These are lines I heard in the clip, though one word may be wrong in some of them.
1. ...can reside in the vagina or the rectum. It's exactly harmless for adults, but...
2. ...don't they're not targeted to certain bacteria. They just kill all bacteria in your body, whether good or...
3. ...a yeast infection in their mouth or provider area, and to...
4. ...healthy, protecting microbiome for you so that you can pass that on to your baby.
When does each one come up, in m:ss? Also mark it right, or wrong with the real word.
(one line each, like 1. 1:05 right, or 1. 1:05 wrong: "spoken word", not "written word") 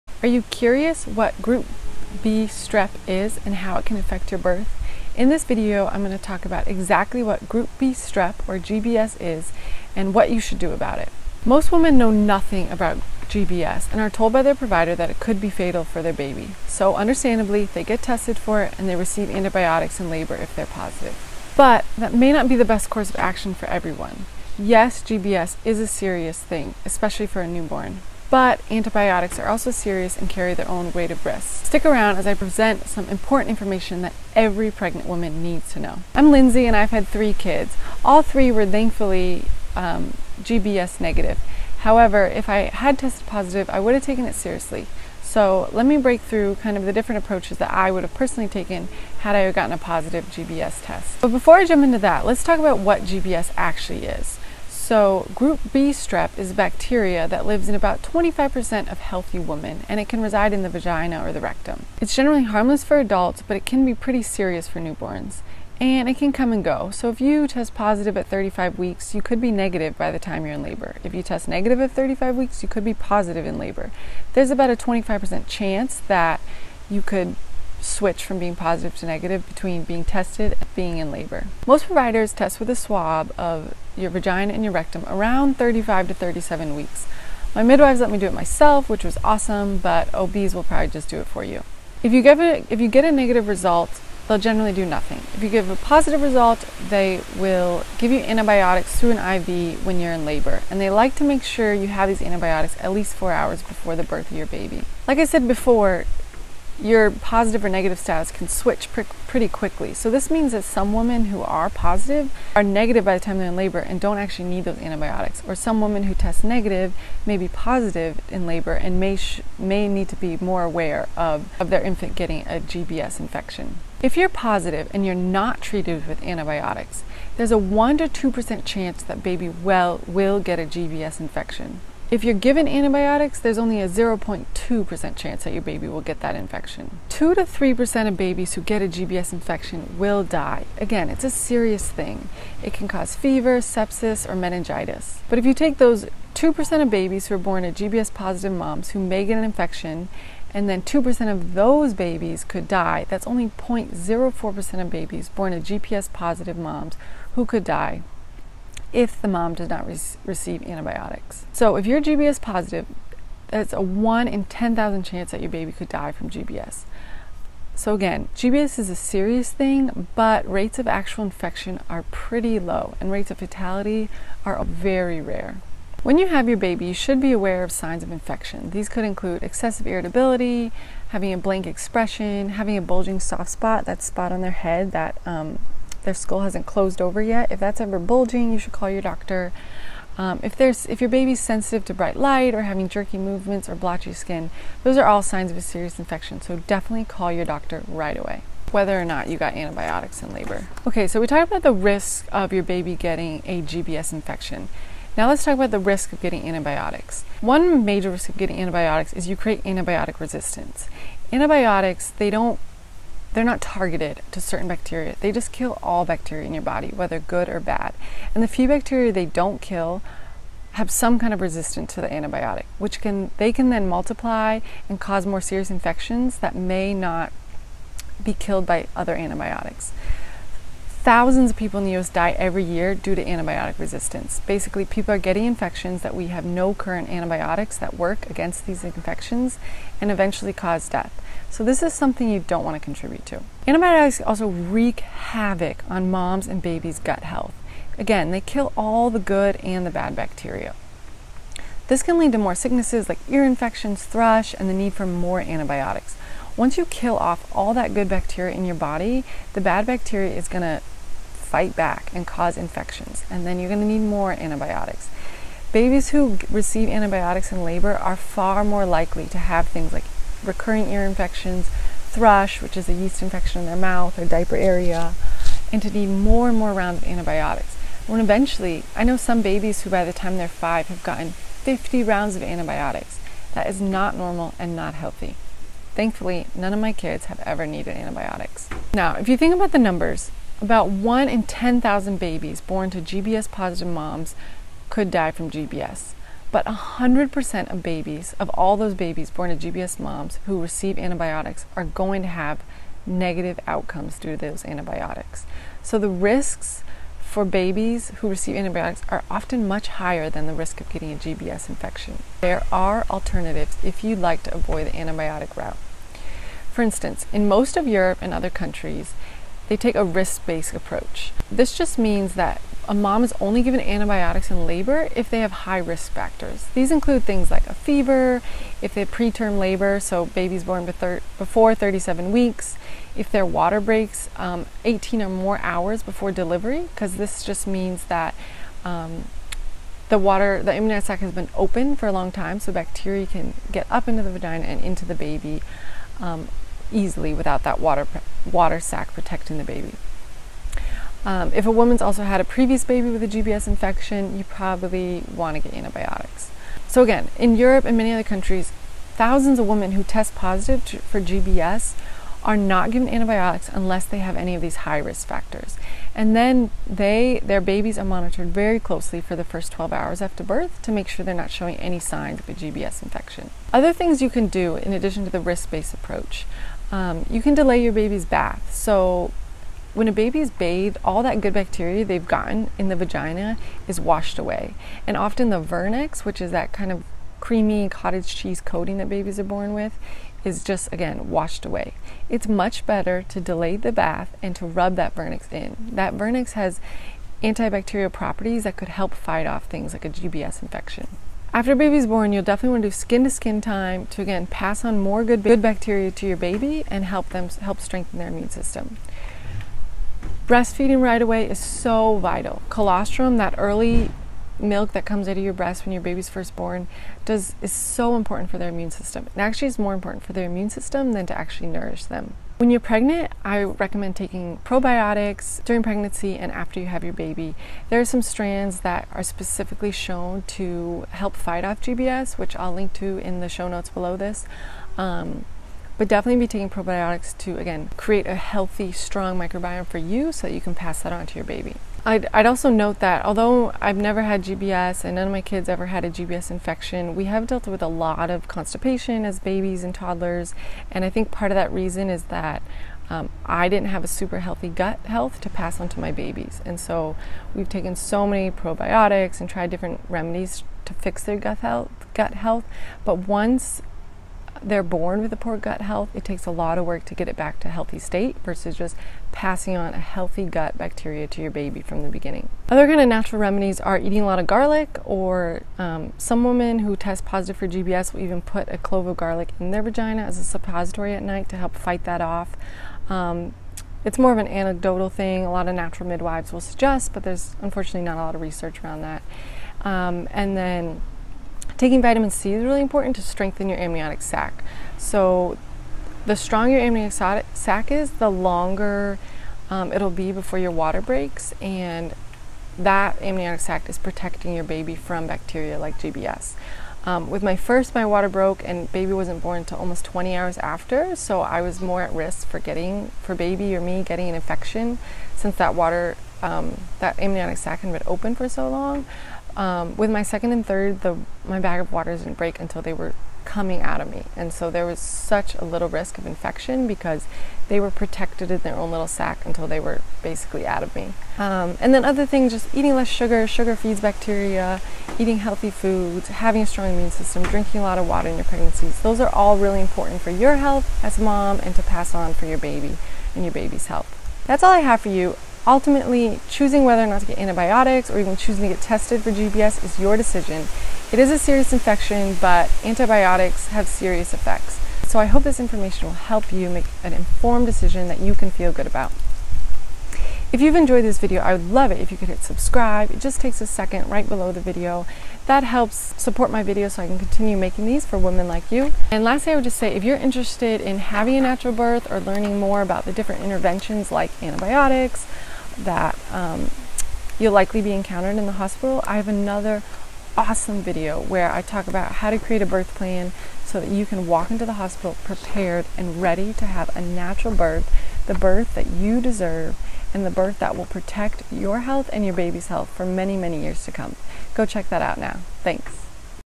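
1. 1:00 wrong: "generally", not "exactly"
2. 3:32 right
3. 4:32 wrong: "diaper", not "provider"
4. 7:18 wrong: "strong", not "protecting".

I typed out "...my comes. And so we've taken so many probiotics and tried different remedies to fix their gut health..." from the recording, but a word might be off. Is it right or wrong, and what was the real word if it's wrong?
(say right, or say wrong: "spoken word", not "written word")
wrong: "babies", not "comes".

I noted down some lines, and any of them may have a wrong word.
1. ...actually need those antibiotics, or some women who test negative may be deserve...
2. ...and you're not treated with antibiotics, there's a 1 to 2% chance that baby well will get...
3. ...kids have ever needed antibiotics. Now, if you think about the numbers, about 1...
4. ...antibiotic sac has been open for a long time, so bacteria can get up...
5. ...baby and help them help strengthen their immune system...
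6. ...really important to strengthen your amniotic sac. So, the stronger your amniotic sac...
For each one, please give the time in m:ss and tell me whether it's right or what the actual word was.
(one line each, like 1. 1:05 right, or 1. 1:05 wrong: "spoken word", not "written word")
1. 1:54 wrong: "positive", not "deserve"
2. 2:04 right
3. 4:46 right
4. 5:40 wrong: "amniotic", not "antibiotic"
5. 6:46 right
6. 8:12 right.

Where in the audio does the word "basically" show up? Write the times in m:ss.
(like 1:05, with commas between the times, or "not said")
3:54, 8:50.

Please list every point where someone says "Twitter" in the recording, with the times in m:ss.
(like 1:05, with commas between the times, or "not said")
not said.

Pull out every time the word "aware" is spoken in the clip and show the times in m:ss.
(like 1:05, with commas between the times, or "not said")
2:00, 2:57.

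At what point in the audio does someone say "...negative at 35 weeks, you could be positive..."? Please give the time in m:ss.
1:11.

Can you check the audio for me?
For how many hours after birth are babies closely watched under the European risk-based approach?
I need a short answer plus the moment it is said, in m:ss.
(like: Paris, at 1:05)
12 hours, at 6:09.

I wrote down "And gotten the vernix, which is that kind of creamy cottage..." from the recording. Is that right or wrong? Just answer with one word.
wrong.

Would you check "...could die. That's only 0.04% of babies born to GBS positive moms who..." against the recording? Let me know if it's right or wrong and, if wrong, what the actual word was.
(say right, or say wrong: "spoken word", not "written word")
right.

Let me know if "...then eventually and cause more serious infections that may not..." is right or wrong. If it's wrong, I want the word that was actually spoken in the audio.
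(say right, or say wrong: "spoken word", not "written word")
wrong: "multiply", not "eventually".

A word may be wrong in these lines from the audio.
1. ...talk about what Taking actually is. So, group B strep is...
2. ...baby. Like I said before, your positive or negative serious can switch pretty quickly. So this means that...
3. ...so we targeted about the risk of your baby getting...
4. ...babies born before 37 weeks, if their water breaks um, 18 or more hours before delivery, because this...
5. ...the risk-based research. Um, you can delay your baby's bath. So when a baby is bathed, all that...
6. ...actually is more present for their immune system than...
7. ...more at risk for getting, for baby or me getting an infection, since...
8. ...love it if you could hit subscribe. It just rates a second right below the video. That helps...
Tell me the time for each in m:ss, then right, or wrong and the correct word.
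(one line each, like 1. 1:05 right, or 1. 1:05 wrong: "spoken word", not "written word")
1. 0:52 wrong: "GBS", not "Taking"
2. 1:44 wrong: "status", not "serious"
3. 3:21 wrong: "talked", not "targeted"
4. 5:30 right
5. 6:15 wrong: "approach", not "research"
6. 6:59 wrong: "important", not "present"
7. 8:31 right
8. 9:21 wrong: "takes", not "rates".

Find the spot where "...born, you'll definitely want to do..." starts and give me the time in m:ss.
6:42.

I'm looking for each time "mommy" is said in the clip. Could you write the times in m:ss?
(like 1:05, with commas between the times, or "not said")
not said.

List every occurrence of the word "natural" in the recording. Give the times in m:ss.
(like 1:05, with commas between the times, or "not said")
7:53, 8:05, 9:31, 9:47.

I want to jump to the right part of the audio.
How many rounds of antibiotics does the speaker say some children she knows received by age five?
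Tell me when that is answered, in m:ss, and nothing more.
4:41.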